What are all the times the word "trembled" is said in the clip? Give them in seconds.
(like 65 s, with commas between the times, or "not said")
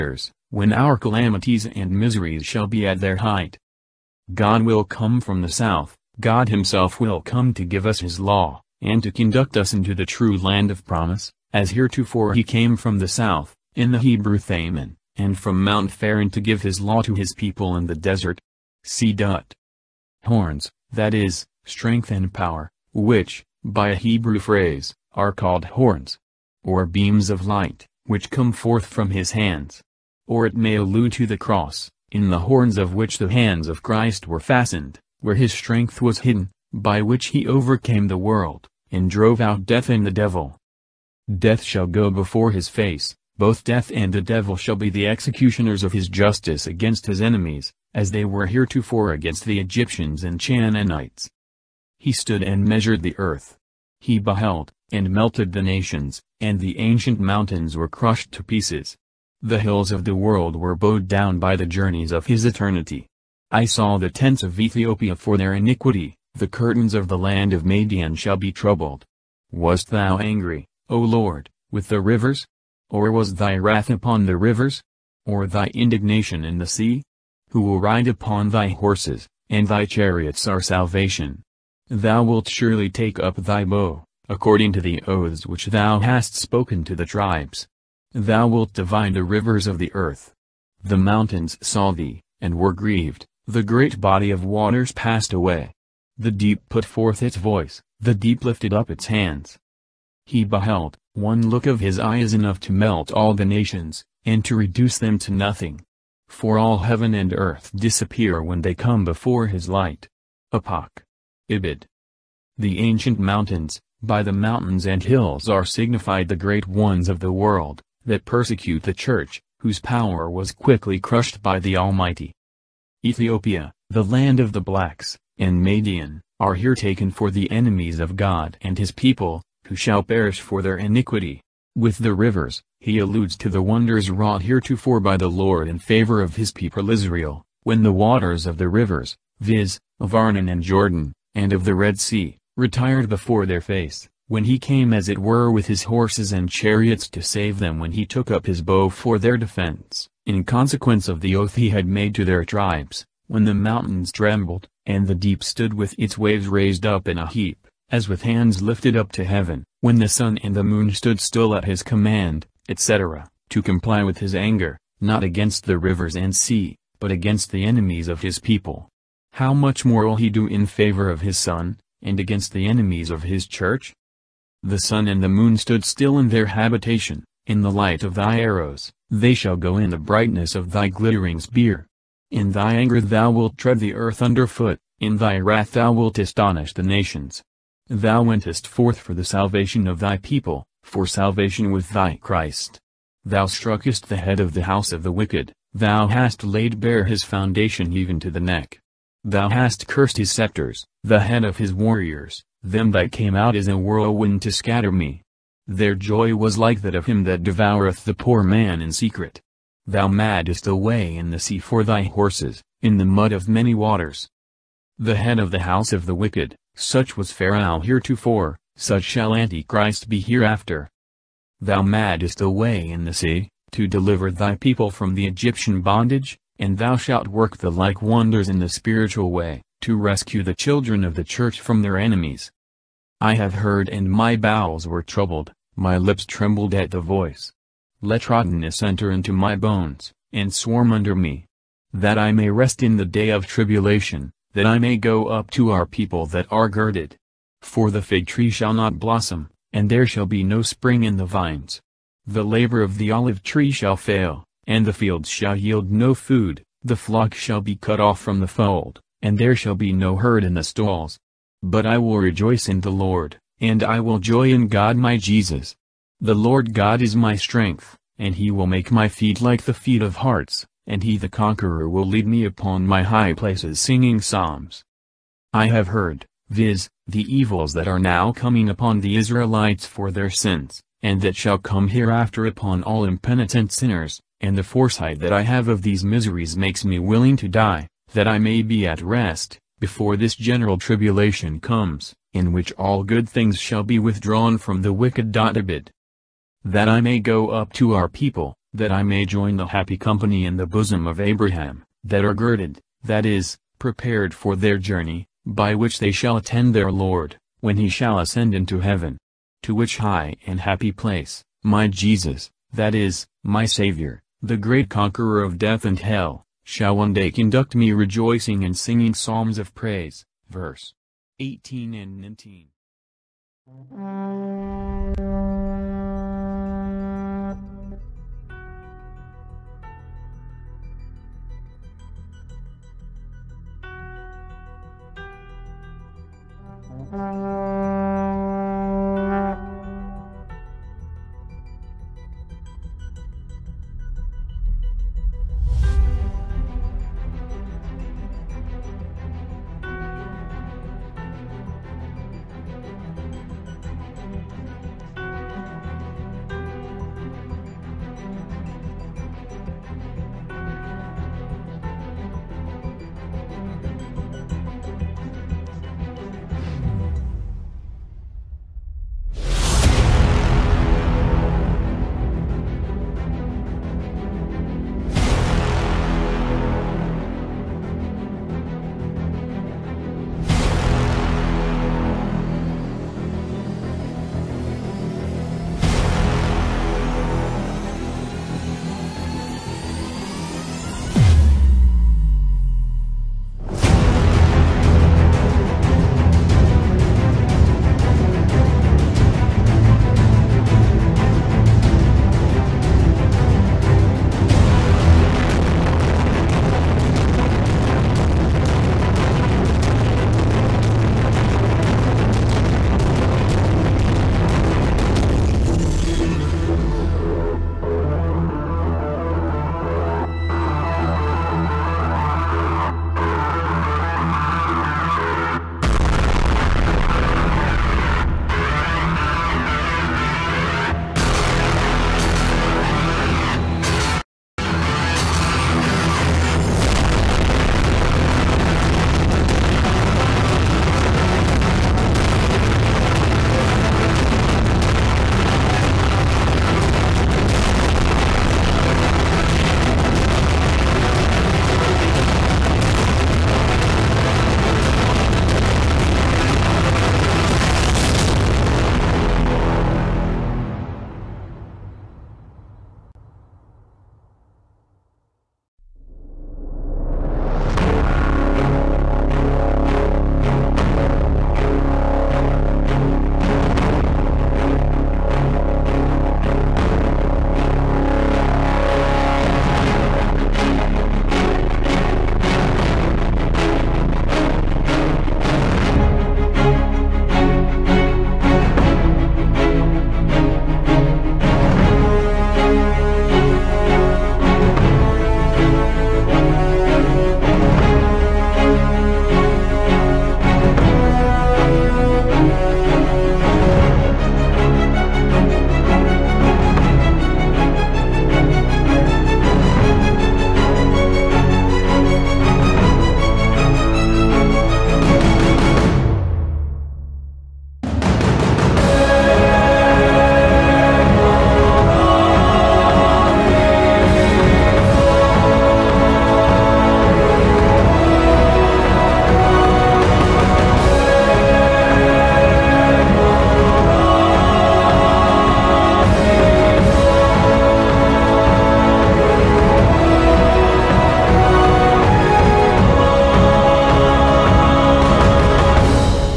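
154 s, 236 s.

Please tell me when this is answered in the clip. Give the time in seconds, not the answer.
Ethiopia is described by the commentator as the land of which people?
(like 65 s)
123 s.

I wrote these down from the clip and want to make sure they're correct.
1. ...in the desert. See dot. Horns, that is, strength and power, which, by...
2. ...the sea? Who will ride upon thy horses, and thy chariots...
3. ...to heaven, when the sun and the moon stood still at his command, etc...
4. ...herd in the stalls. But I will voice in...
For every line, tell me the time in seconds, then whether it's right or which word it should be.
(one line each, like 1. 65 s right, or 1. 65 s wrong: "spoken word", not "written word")
1. 17 s right
2. 76 s right
3. 159 s right
4. 260 s wrong: "rejoice", not "voice".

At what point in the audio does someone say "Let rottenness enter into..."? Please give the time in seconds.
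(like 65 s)
238 s.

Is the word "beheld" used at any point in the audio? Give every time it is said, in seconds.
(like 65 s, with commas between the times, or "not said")
54 s, 100 s.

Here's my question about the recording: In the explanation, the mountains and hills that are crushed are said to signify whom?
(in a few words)
The great ones of the world.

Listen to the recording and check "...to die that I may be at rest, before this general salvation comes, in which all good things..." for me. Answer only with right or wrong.
wrong.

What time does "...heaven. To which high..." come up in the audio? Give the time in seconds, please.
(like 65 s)
308 s.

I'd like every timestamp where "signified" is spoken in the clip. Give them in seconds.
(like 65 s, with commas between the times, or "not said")
115 s.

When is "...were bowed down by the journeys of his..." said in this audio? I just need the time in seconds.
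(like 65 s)
60 s.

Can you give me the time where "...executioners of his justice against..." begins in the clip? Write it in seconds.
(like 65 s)
45 s.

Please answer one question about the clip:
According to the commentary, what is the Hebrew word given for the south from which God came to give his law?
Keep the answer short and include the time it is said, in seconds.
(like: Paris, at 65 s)
Thaman, at 14 s.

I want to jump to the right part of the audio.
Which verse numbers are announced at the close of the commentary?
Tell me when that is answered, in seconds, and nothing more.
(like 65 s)
320 s.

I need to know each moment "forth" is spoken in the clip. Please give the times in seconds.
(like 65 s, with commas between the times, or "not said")
28 s, 96 s, 188 s.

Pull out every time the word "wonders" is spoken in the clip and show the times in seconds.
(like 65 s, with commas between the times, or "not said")
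133 s, 228 s.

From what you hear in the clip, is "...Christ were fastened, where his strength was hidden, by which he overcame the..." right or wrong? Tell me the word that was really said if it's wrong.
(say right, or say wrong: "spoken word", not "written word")
right.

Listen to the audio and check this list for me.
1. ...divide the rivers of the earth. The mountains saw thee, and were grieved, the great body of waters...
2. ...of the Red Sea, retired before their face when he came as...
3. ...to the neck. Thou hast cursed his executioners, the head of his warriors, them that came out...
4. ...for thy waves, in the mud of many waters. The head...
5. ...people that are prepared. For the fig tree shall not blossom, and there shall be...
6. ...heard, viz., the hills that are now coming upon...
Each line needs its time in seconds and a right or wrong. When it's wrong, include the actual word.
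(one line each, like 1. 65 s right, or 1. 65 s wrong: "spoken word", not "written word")
1. 88 s right
2. 141 s right
3. 198 s wrong: "scepters", not "executioners"
4. 211 s wrong: "horses", not "waves"
5. 245 s wrong: "girded", not "prepared"
6. 275 s wrong: "evils", not "hills".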